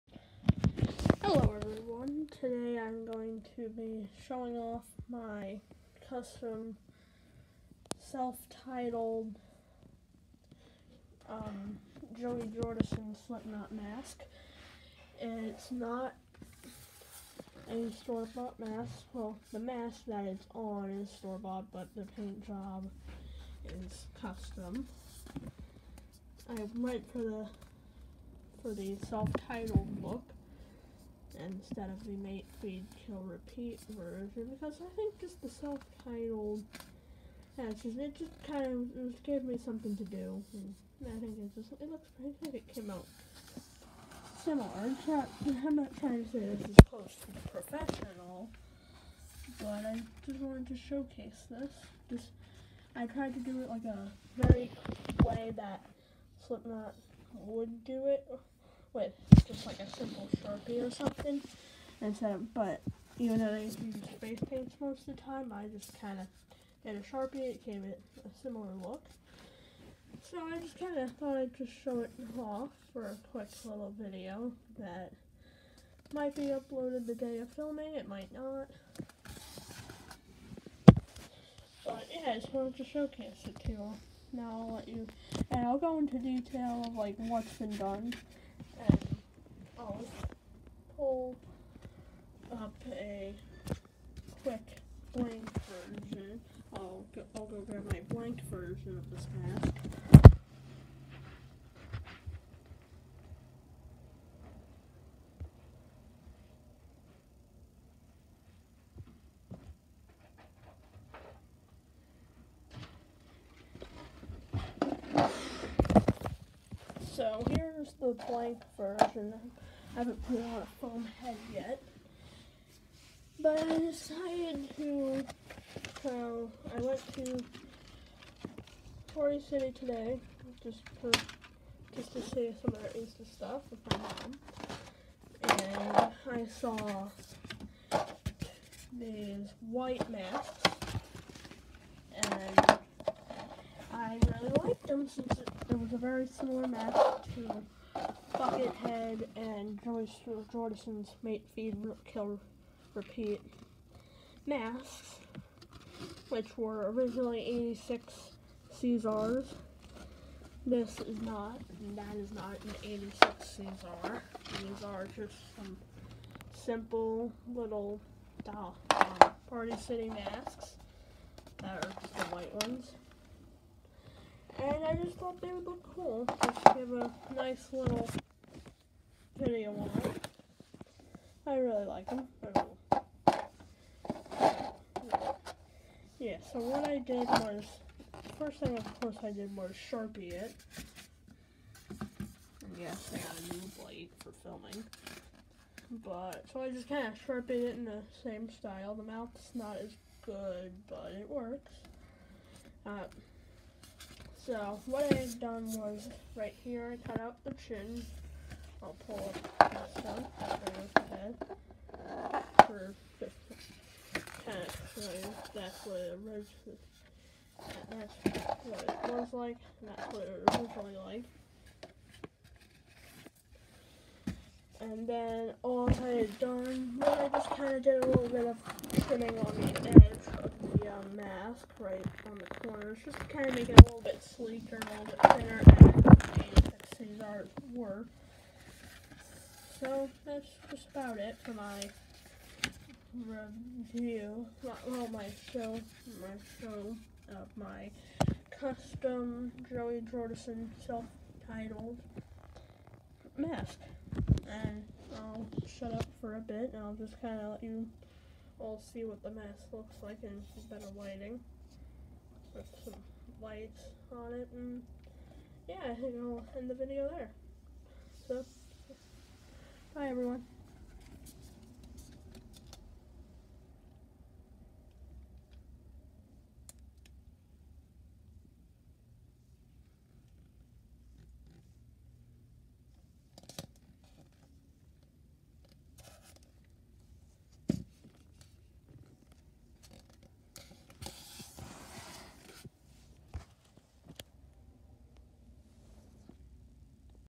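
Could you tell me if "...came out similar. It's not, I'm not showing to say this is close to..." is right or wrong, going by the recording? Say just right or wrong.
wrong.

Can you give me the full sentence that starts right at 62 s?
Instead of, but even though they use face paints most of the time, I just kind of did a Sharpie.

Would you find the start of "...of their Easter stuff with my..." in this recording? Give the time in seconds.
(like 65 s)
132 s.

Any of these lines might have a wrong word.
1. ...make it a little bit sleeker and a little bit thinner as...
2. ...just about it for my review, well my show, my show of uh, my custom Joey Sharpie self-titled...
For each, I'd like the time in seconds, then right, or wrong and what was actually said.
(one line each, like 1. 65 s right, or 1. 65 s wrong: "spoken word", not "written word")
1. 233 s right
2. 240 s wrong: "Jordison", not "Sharpie".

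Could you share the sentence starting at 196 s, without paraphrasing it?
But, so I just kind of sharpened it in the same style.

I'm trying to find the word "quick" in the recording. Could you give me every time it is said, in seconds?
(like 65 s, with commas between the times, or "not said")
73 s, 94 s.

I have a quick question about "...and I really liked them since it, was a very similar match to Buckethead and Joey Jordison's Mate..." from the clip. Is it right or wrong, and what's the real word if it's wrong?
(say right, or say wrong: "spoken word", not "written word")
right.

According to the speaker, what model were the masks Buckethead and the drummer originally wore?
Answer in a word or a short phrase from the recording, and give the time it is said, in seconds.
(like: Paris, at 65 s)
86 Caesars, at 157 s.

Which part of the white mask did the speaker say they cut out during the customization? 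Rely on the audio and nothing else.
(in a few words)
The chin.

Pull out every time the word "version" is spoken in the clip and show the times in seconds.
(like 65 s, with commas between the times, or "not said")
33 s, 118 s.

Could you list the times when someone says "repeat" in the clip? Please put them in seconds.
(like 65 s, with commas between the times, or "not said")
33 s, 152 s.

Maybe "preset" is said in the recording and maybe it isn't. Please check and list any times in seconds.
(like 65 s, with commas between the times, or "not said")
not said.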